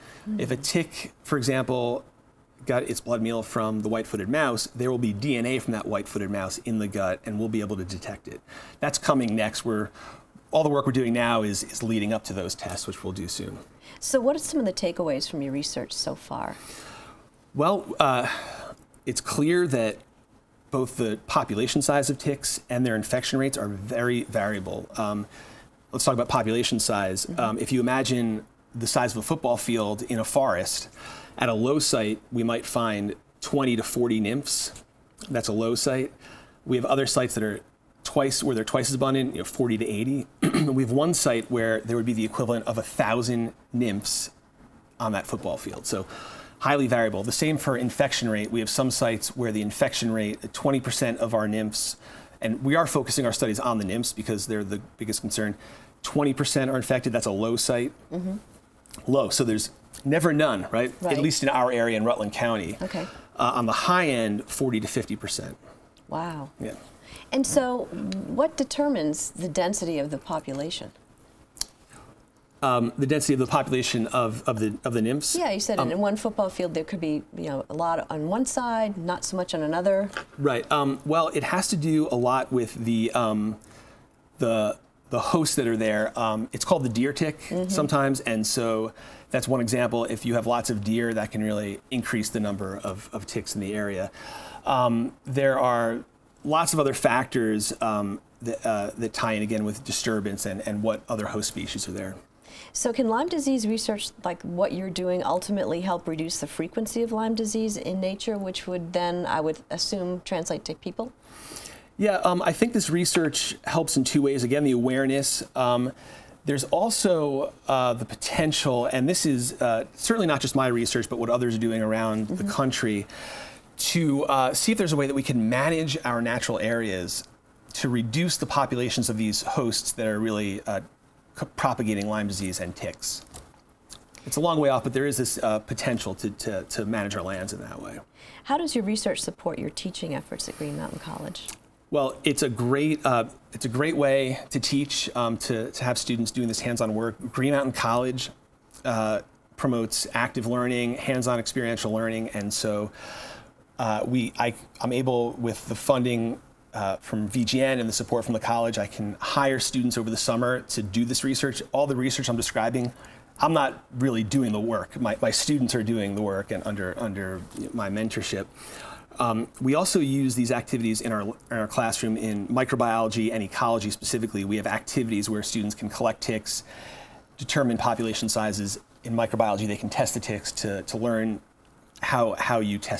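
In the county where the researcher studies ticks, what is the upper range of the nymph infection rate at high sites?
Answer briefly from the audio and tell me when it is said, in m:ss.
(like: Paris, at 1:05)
40 to 50%, at 1:04.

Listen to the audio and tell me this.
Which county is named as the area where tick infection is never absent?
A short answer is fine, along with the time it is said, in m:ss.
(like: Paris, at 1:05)
Rutland County, at 1:02.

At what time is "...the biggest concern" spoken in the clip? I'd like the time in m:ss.
0:54.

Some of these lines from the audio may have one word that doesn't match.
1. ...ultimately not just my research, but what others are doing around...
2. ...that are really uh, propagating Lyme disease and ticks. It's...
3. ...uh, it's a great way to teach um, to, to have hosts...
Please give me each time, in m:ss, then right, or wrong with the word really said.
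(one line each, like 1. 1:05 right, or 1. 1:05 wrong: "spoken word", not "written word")
1. 1:59 wrong: "certainly", not "ultimately"
2. 2:09 right
3. 2:23 wrong: "students", not "hosts".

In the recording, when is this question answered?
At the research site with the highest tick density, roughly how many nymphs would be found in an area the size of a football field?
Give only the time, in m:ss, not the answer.
0:42.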